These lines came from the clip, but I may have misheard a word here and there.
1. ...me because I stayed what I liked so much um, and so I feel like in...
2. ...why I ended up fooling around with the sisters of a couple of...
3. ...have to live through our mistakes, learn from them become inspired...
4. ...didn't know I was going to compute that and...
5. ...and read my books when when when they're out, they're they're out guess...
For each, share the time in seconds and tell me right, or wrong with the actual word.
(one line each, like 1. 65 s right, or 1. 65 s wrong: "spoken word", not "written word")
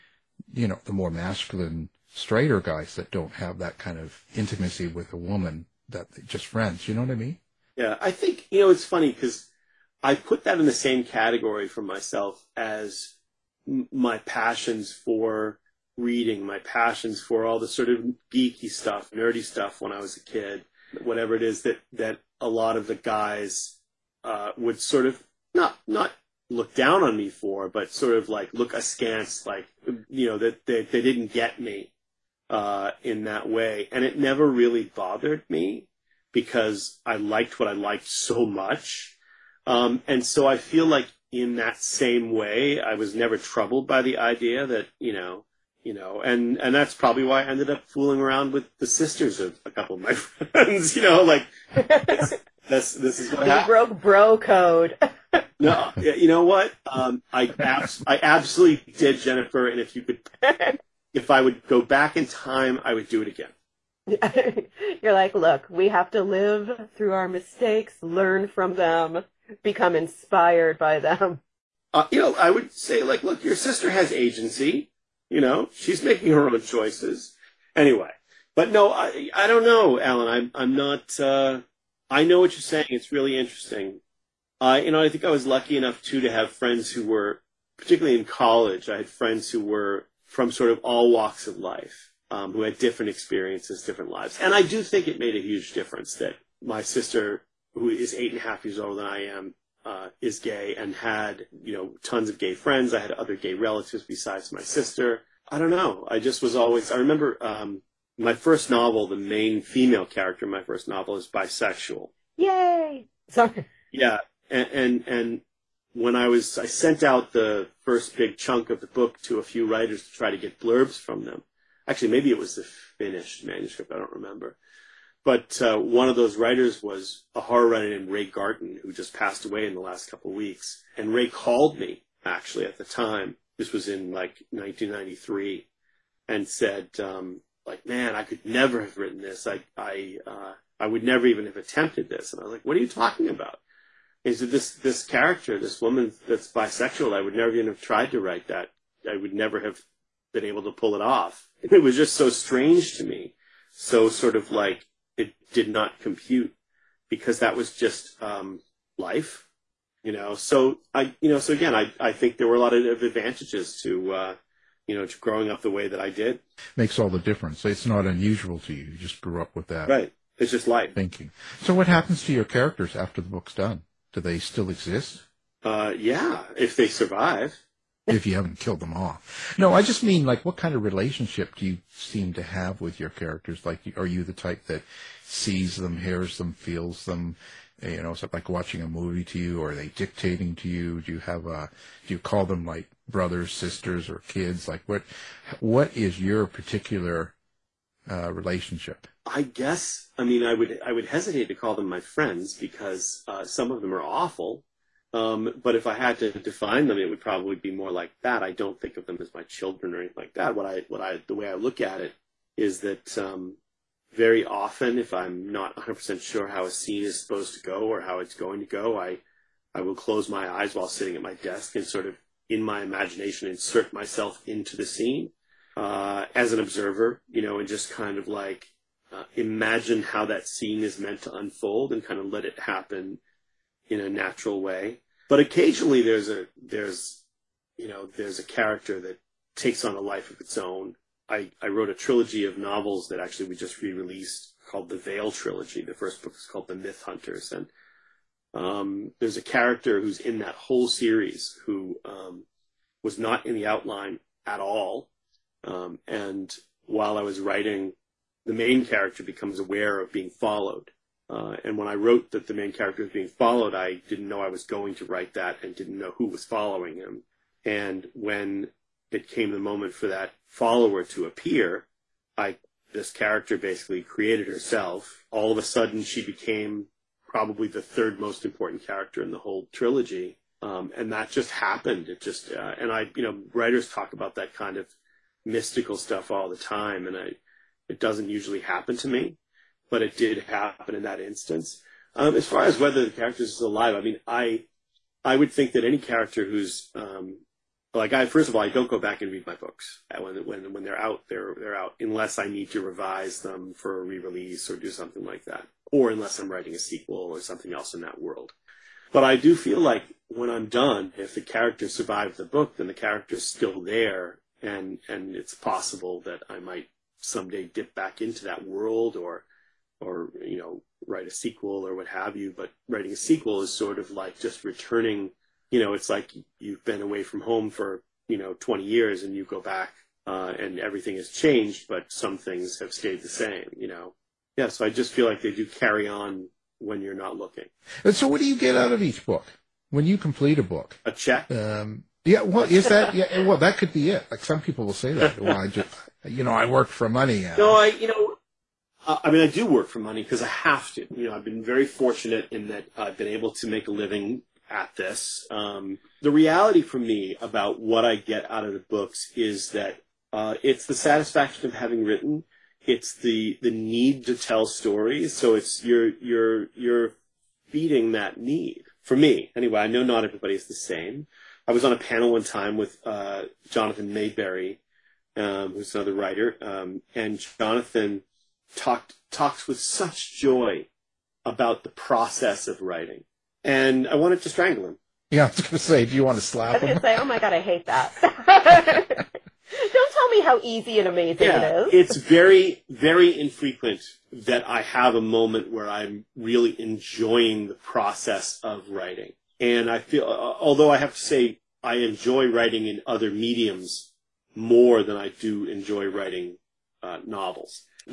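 1. 35 s wrong: "liked", not "stayed"
2. 47 s right
3. 65 s right
4. 264 s wrong: "write", not "compute"
5. 299 s wrong: "unless", not "guess".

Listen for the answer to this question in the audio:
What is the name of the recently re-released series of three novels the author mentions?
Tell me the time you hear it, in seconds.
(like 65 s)
244 s.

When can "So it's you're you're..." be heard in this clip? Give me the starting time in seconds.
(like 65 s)
365 s.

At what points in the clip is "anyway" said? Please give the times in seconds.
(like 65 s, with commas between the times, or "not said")
77 s, 369 s.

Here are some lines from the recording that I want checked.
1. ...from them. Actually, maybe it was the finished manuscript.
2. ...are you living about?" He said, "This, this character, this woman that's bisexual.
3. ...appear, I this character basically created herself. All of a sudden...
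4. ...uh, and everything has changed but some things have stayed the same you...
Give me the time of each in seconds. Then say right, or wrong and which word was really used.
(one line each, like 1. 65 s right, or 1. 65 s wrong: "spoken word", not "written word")
1. 120 s right
2. 142 s wrong: "talking", not "living"
3. 271 s right
4. 330 s right.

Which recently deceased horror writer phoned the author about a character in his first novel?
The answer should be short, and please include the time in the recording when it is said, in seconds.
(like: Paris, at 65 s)
Ray Garton, at 128 s.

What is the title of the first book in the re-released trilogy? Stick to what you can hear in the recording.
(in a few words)
The Myth Hunters.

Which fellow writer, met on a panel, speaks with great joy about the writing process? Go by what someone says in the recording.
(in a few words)
Jonathan Maberry.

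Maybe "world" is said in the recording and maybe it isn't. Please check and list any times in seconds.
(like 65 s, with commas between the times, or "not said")
308 s, 318 s.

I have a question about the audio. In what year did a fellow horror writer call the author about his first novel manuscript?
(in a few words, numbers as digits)
1993.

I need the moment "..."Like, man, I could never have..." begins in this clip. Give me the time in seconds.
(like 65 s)
137 s.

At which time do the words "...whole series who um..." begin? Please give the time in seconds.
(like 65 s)
250 s.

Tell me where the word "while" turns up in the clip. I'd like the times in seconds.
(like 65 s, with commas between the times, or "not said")
220 s, 256 s.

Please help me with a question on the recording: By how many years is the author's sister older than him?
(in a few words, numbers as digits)
8 and a half.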